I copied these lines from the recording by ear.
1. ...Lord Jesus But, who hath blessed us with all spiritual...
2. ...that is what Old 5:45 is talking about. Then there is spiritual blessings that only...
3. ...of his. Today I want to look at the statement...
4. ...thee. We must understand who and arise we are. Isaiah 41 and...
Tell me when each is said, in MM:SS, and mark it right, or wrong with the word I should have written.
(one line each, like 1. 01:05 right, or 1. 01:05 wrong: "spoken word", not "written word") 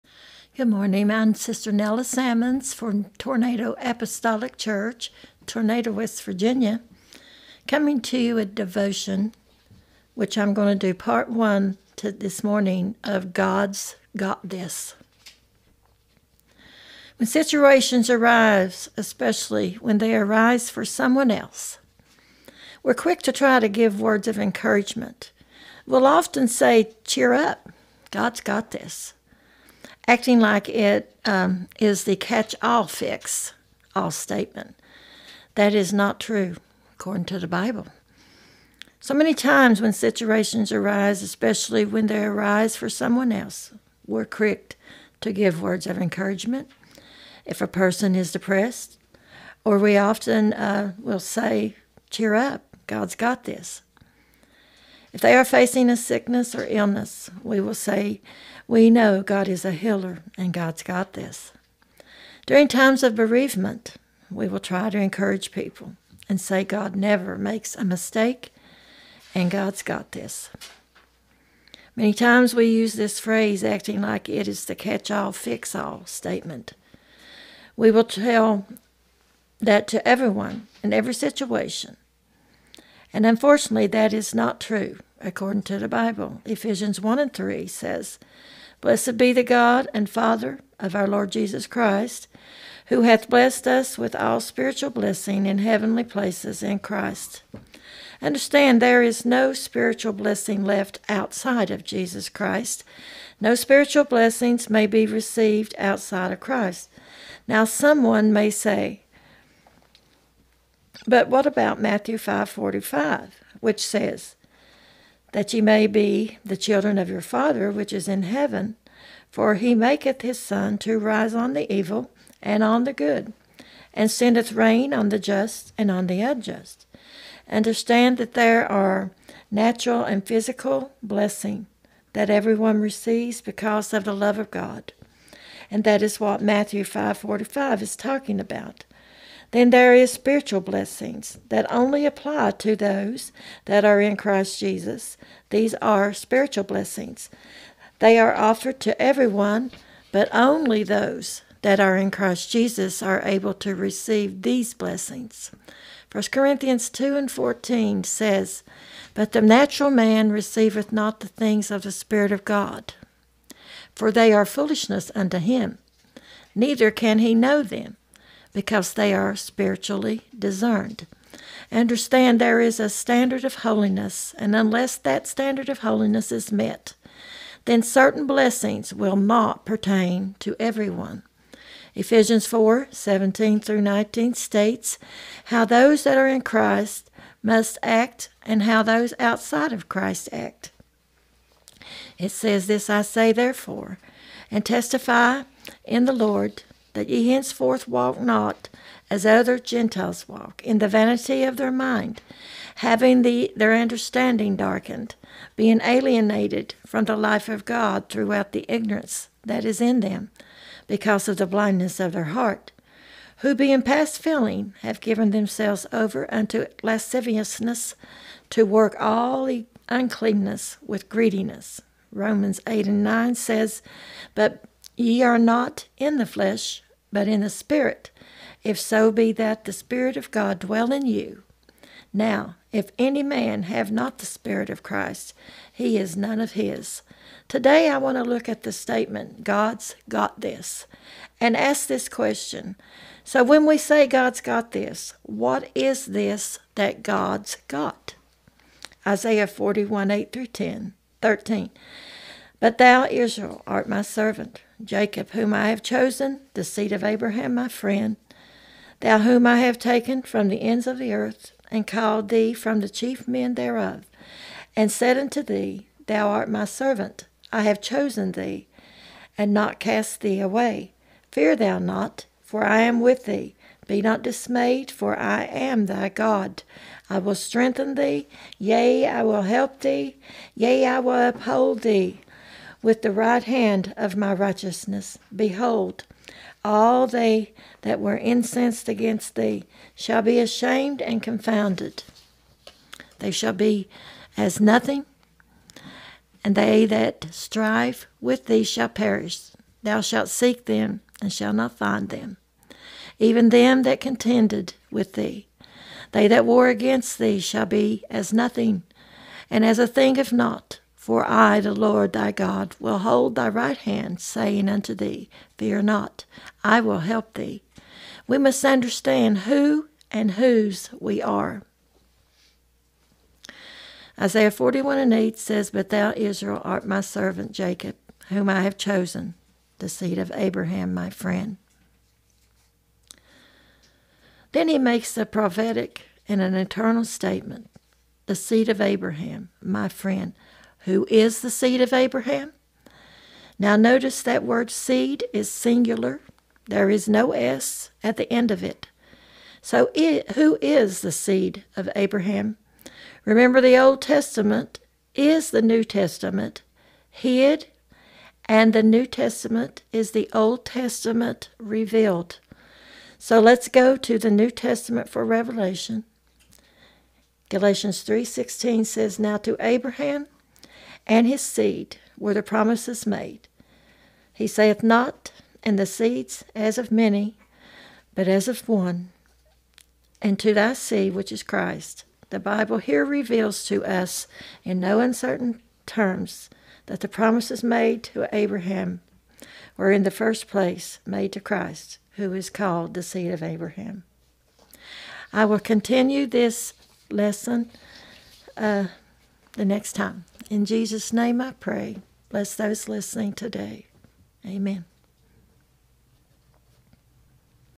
1. 01:31 wrong: "Christ", not "But"
2. 02:15 wrong: "Matthew", not "Old"
3. 03:56 right
4. 05:17 wrong: "whose", not "arise".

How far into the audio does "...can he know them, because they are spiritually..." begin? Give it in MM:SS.
02:46.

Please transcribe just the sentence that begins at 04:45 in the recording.
Behold, all they that were incensed against thee shall be ashamed and confounded.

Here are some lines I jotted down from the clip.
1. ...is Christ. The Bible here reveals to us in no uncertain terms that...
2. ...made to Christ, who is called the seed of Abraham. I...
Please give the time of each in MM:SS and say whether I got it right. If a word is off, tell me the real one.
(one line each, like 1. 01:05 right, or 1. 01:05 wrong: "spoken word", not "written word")
1. 06:21 right
2. 06:31 right.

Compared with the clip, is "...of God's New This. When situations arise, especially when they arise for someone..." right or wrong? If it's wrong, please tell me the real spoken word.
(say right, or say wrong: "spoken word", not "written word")
wrong: "Got", not "New".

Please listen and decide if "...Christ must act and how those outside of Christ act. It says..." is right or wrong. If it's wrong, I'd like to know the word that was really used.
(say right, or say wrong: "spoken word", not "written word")
right.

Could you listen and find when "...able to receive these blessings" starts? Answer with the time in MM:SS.
02:33.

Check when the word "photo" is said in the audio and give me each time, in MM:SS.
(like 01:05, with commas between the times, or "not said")
not said.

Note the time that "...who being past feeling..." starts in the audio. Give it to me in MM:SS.
03:33.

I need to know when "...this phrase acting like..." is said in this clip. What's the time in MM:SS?
01:12.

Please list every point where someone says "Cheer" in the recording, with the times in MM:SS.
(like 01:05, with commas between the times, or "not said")
00:27, 00:52.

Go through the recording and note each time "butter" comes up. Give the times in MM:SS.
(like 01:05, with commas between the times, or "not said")
not said.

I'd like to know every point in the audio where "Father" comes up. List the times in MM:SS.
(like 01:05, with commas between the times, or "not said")
01:30, 01:57.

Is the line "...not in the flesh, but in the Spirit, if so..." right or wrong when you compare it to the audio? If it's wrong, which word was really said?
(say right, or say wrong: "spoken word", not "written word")
right.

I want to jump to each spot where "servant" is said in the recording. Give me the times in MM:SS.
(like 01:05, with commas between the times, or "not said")
04:14, 04:26, 05:27.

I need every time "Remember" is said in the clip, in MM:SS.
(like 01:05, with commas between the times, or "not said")
05:53.